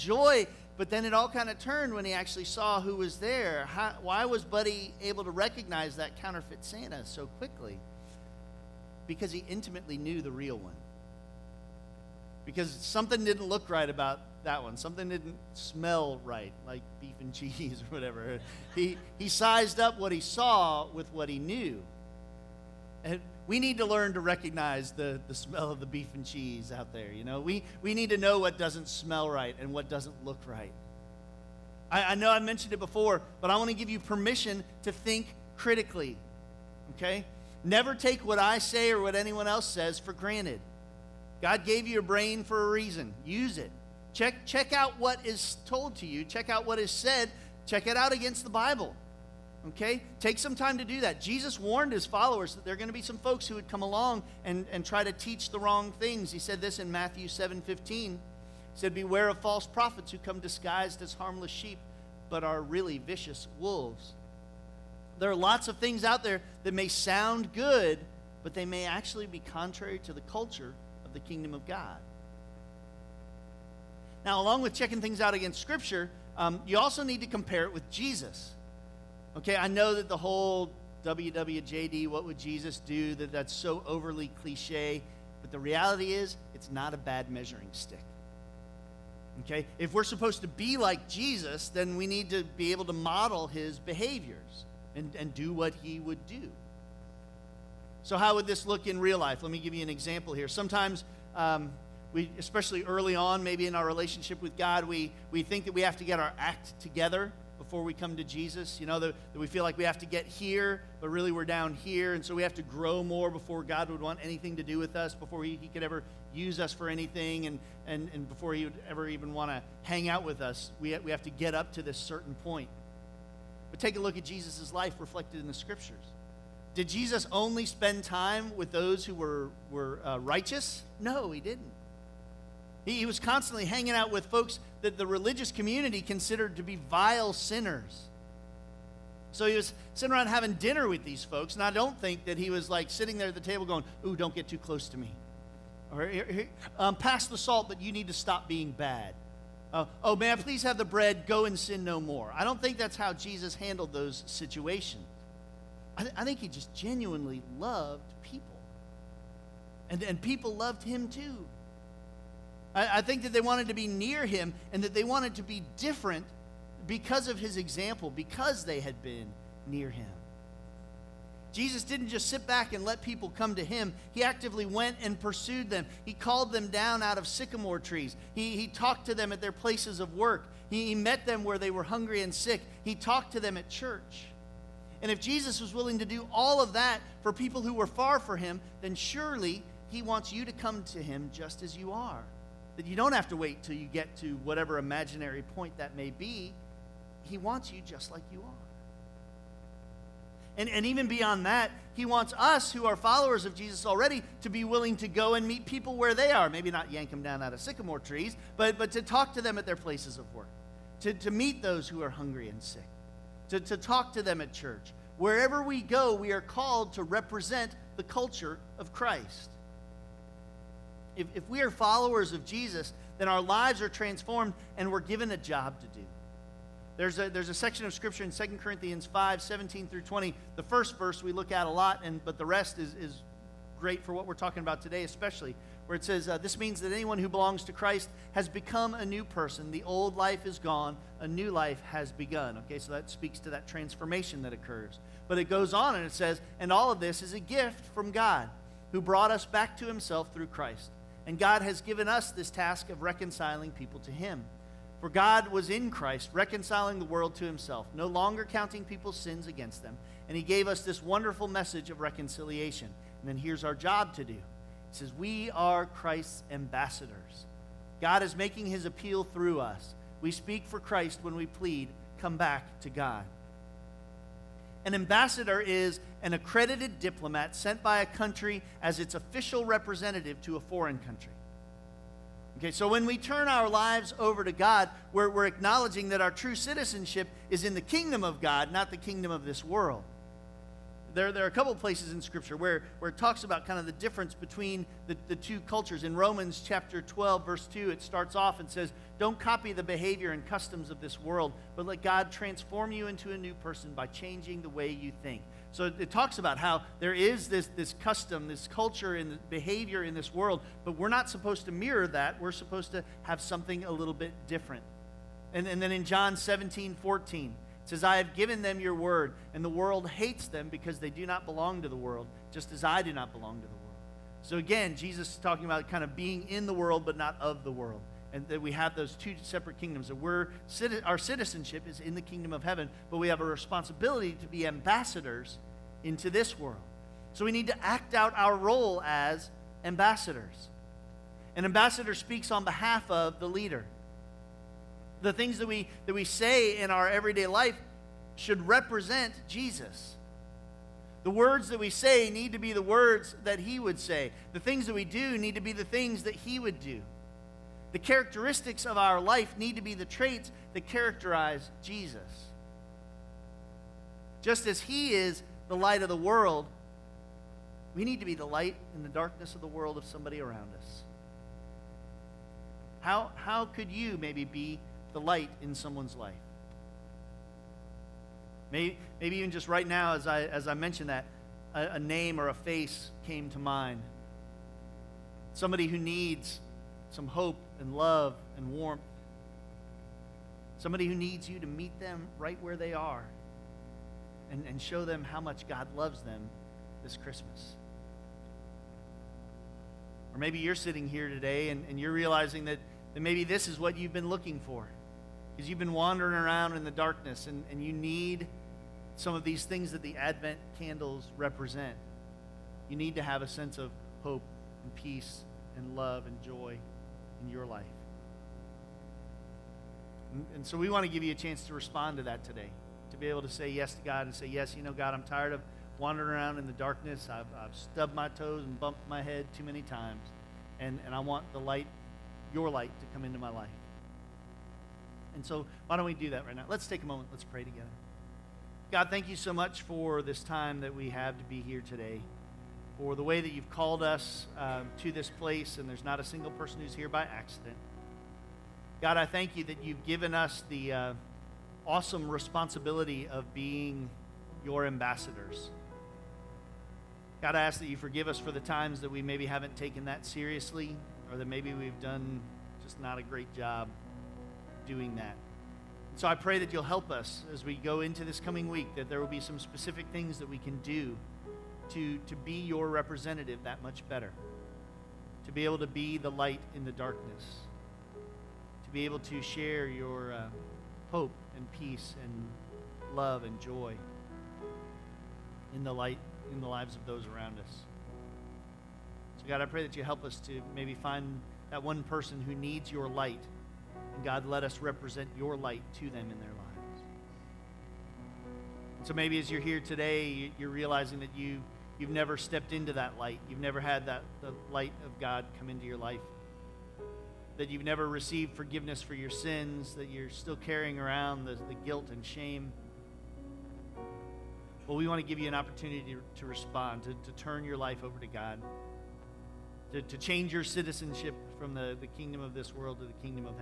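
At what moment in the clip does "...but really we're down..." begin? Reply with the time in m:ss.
1:51.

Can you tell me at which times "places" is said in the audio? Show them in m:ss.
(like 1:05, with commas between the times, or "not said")
2:59, 3:29, 4:51, 7:25.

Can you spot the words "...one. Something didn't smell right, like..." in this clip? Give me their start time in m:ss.
0:14.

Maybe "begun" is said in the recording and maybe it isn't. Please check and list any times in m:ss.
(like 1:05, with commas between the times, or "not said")
4:02.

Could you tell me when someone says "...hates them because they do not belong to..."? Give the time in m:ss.
5:20.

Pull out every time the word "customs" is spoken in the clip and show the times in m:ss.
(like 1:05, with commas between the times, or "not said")
5:00, 5:08.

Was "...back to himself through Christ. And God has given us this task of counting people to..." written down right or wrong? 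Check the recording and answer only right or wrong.
wrong.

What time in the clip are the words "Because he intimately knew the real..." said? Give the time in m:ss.
0:09.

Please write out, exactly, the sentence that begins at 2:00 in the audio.
We, we have to get up to this certain point.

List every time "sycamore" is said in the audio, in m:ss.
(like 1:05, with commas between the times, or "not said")
2:57, 3:27.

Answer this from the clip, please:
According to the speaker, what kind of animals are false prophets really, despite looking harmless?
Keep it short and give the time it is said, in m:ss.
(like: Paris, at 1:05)
Vicious wolves, at 1:02.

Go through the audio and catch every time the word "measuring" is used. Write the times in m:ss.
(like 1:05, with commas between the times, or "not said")
1:27.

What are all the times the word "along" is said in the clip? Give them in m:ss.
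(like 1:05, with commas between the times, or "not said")
0:53, 1:14.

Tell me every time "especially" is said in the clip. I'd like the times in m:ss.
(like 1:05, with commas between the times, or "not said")
1:42, 3:55.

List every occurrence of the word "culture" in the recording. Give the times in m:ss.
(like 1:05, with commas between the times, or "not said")
1:10, 3:38, 4:55, 5:08.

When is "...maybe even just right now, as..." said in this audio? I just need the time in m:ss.
6:19.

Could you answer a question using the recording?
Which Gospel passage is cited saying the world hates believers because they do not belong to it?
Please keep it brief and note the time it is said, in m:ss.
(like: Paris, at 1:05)
John 17:14, at 5:16.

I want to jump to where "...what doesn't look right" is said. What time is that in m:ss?
0:29.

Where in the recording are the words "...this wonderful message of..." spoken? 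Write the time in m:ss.
4:20.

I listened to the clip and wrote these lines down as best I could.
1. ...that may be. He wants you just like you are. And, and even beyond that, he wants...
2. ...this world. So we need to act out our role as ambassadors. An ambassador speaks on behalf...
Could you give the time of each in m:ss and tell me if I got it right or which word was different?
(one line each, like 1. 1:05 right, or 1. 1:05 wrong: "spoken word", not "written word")
1. 3:15 right
2. 5:36 right.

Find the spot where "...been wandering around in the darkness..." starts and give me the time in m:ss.
6:45.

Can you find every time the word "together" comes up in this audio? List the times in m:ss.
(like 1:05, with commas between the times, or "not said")
1:46, 7:17.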